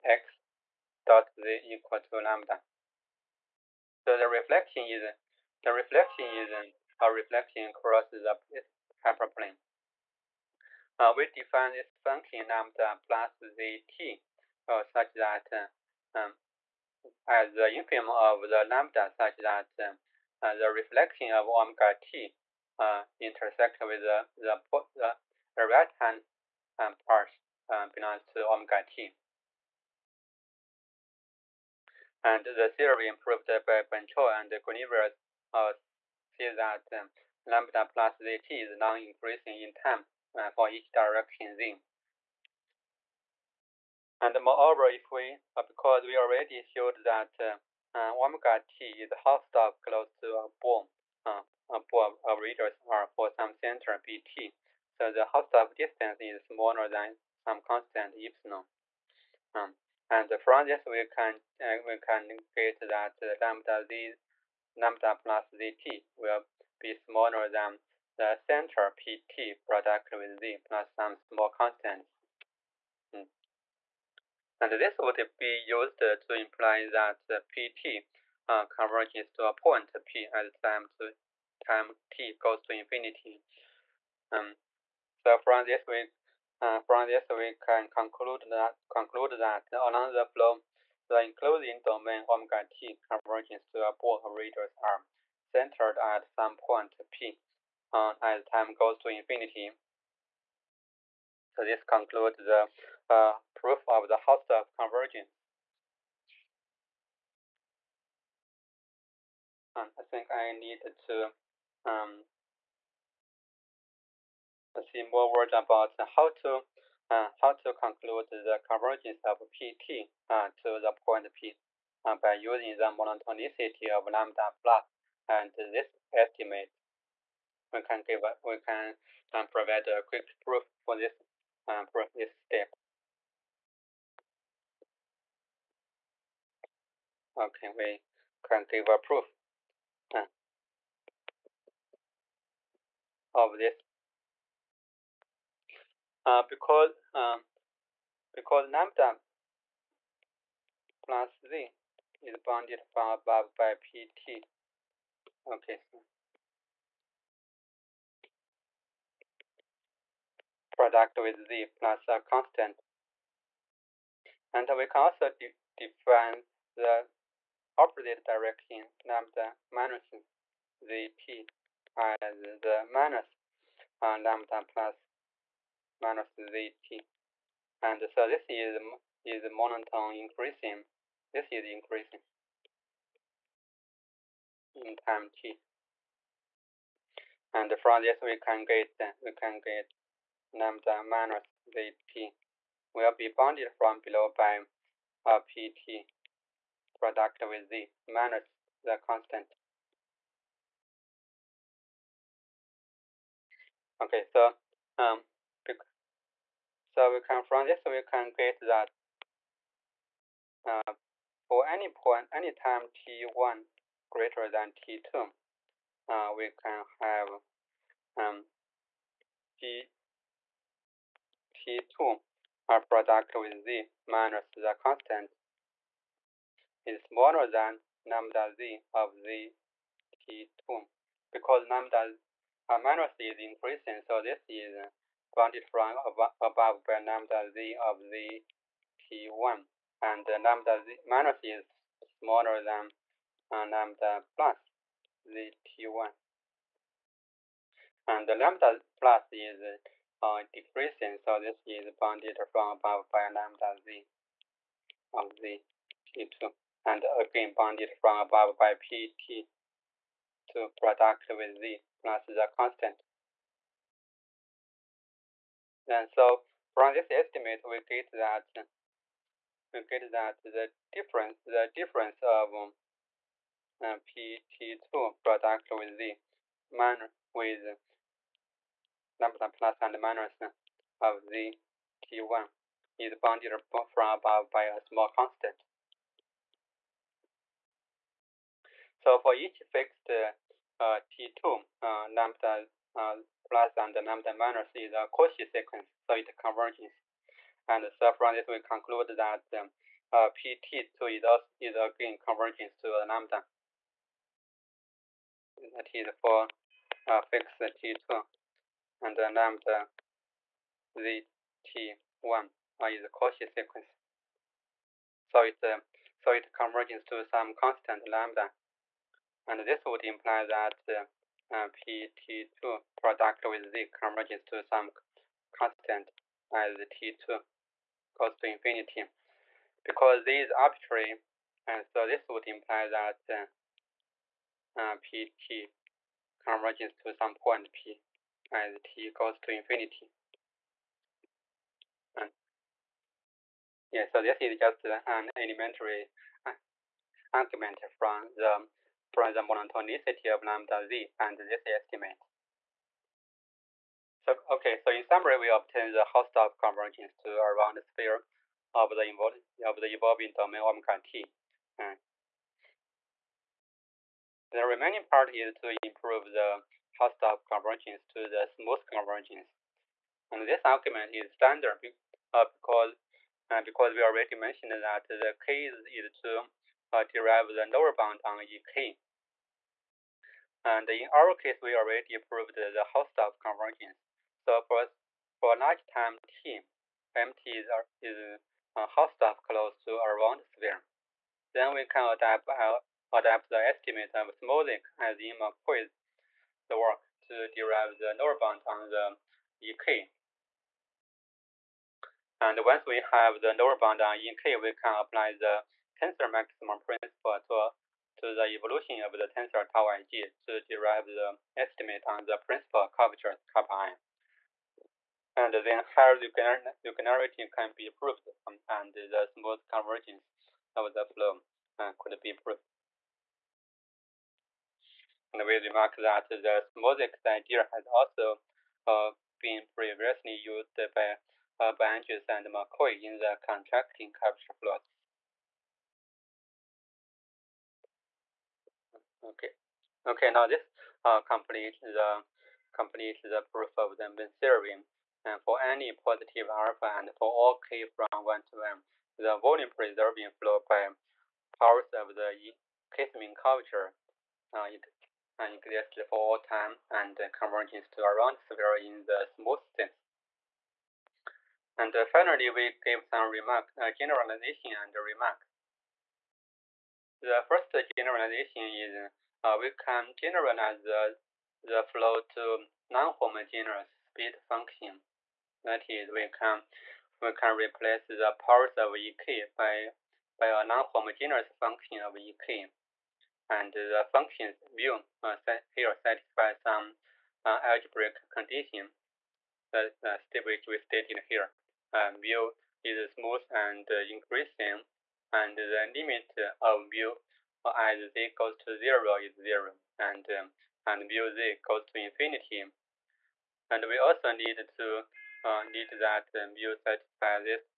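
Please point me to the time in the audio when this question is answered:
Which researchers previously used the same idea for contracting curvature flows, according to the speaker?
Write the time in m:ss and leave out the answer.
7:11.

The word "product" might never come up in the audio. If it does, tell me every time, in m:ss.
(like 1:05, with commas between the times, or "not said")
1:09, 2:40, 3:16, 3:42, 4:20, 4:35, 5:22.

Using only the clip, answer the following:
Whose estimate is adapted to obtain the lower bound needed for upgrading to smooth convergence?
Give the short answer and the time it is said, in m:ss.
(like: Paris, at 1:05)
Smolik, at 6:34.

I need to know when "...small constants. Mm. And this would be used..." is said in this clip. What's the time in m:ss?
1:11.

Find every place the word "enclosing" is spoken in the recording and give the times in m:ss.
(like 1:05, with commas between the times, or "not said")
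1:31.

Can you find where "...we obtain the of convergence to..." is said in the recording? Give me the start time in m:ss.
5:55.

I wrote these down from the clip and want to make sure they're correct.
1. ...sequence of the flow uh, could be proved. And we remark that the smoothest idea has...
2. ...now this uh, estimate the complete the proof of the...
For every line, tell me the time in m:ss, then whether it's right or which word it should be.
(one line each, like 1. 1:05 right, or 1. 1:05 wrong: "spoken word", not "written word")
1. 6:59 wrong: "convergence", not "sequence"
2. 7:20 wrong: "complete", not "estimate".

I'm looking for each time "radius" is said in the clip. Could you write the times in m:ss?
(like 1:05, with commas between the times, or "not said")
0:52, 1:34.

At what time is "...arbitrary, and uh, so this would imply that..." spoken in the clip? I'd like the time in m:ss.
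5:30.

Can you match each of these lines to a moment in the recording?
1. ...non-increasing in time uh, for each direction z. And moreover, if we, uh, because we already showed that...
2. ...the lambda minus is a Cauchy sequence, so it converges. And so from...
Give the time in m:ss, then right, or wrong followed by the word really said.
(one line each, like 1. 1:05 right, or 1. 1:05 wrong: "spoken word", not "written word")
1. 0:38 right
2. 4:53 right.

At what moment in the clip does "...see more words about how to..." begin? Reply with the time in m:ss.
1:54.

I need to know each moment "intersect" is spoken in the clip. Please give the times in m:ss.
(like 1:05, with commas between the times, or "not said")
0:23.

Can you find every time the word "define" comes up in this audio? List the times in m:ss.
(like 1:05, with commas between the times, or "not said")
0:11, 2:45.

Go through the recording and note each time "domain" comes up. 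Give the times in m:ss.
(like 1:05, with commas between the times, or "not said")
1:31, 6:00.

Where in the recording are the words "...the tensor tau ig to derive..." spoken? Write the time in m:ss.
6:49.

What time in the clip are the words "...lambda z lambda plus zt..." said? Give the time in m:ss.
1:03.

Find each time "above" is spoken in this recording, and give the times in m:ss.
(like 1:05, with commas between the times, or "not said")
0:51, 2:33, 3:56, 4:12, 4:18, 4:44.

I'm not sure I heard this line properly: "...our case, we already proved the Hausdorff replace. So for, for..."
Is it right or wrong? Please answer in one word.
wrong.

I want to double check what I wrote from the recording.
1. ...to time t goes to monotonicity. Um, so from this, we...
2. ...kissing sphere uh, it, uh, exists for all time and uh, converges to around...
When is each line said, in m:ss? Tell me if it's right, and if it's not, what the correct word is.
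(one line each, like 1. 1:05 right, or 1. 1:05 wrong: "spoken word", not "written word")
1. 1:20 wrong: "infinity", not "monotonicity"
2. 7:32 wrong: "culture", not "sphere".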